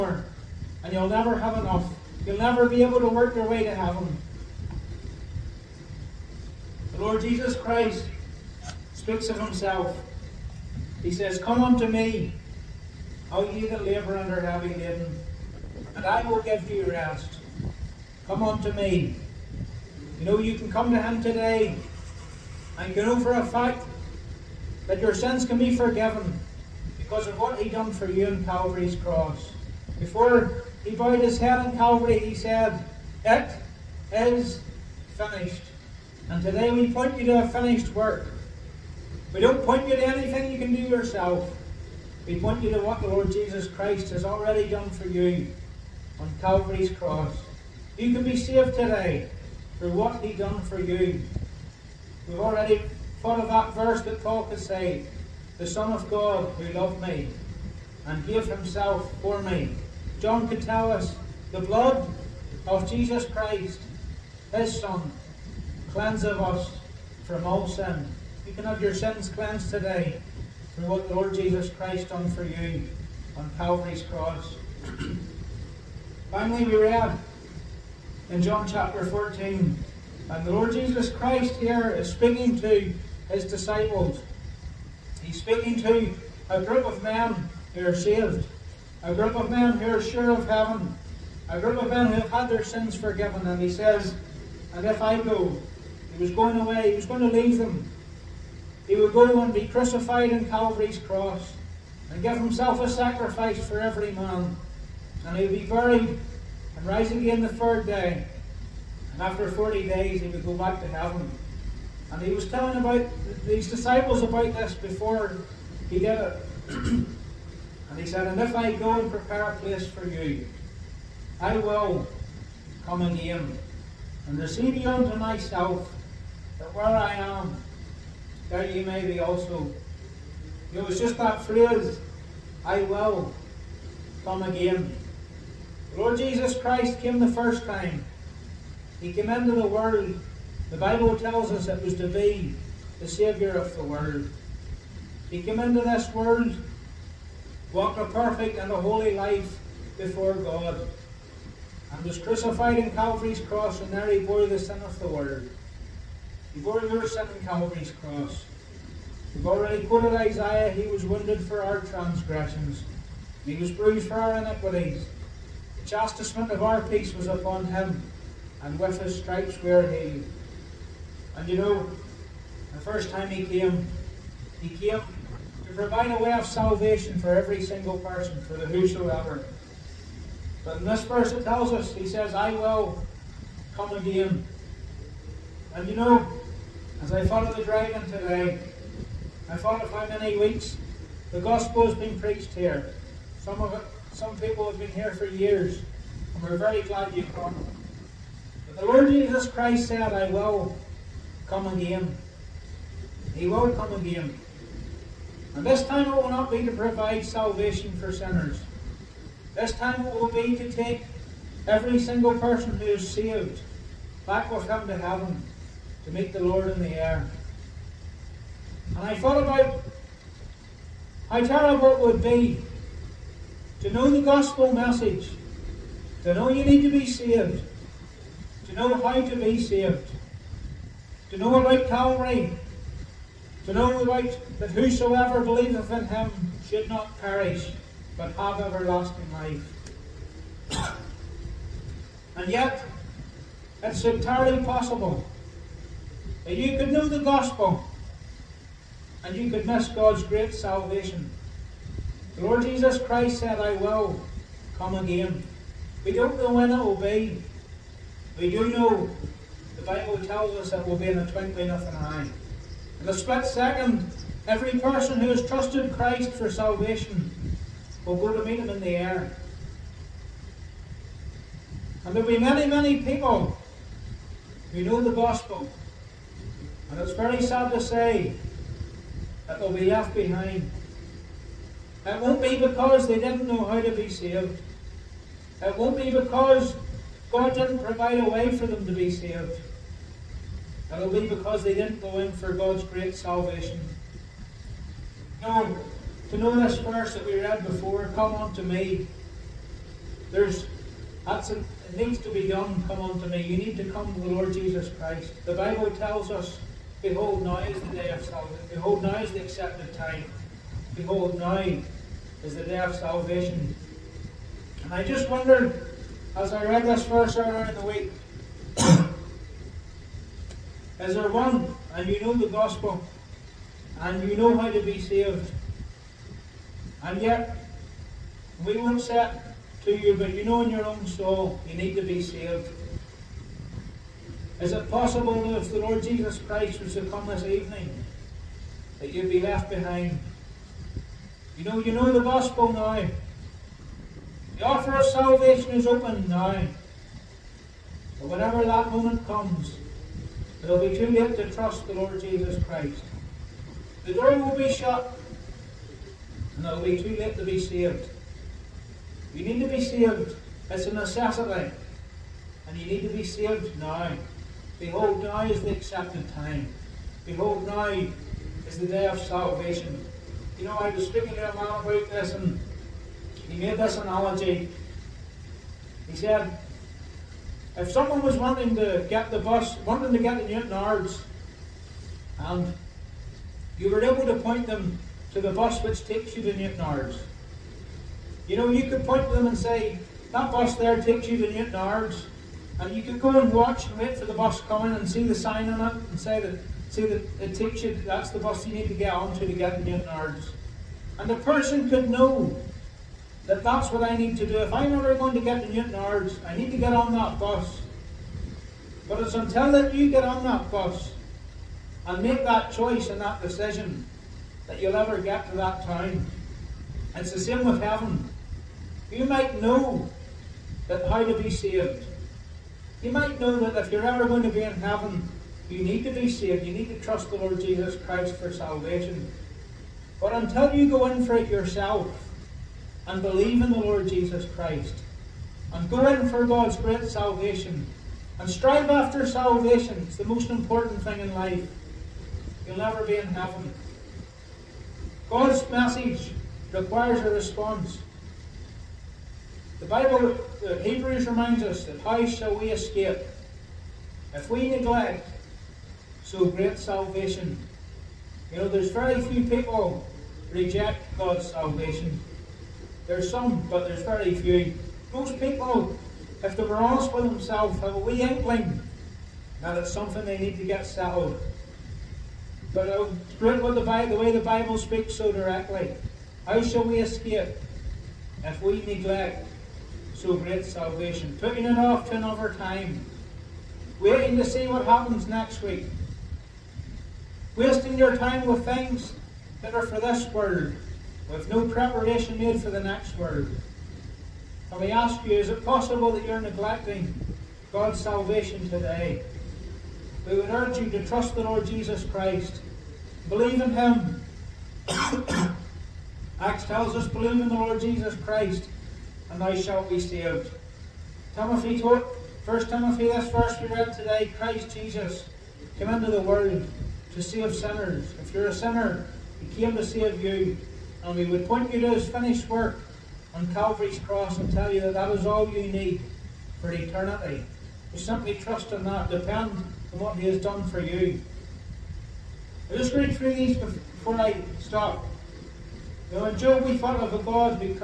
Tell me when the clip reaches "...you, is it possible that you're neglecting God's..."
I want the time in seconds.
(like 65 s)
495 s.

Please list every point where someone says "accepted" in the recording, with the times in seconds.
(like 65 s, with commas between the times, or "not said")
309 s, 365 s.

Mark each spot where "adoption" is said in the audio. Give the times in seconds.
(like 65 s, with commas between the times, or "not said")
not said.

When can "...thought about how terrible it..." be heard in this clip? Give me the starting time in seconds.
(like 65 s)
219 s.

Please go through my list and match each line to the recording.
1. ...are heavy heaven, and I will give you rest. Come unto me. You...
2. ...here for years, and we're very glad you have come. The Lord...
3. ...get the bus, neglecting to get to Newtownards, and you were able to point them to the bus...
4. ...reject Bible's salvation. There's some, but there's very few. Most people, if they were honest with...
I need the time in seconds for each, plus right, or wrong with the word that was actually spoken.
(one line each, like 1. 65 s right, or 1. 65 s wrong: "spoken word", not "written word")
1. 14 s wrong: "laden", not "heaven"
2. 194 s right
3. 379 s wrong: "wanting", not "neglecting"
4. 460 s wrong: "God", not "Bible".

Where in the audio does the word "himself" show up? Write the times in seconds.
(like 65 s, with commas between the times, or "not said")
9 s, 58 s, 102 s.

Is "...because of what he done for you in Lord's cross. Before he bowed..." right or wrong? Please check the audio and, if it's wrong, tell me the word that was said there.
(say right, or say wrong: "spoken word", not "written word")
wrong: "Calvary", not "Lord".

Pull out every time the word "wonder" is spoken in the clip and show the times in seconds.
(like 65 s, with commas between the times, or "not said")
315 s.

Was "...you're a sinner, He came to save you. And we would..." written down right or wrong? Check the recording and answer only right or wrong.
right.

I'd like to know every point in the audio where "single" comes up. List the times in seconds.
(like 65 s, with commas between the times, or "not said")
177 s, 211 s.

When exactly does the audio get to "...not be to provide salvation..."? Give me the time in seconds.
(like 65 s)
206 s.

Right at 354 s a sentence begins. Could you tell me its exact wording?
The door will be shut, and it'll be too late to be saved.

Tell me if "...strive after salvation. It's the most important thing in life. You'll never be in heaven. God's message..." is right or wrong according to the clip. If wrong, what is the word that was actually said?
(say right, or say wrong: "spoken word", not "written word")
right.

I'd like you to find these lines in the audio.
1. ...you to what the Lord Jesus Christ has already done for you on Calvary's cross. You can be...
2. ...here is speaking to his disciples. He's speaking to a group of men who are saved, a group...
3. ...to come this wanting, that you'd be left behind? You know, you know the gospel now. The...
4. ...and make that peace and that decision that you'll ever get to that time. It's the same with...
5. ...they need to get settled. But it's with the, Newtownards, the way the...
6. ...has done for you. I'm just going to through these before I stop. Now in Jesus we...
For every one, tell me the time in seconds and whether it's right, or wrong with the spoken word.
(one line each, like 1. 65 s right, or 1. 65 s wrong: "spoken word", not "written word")
1. 42 s right
2. 81 s right
3. 336 s wrong: "evening", not "wanting"
4. 412 s wrong: "choice", not "peace"
5. 470 s wrong: "Bible", not "Newtownards"
6. 530 s wrong: "Job", not "Jesus".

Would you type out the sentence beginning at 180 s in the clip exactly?
But in this verse it tells us, he says, I will come again.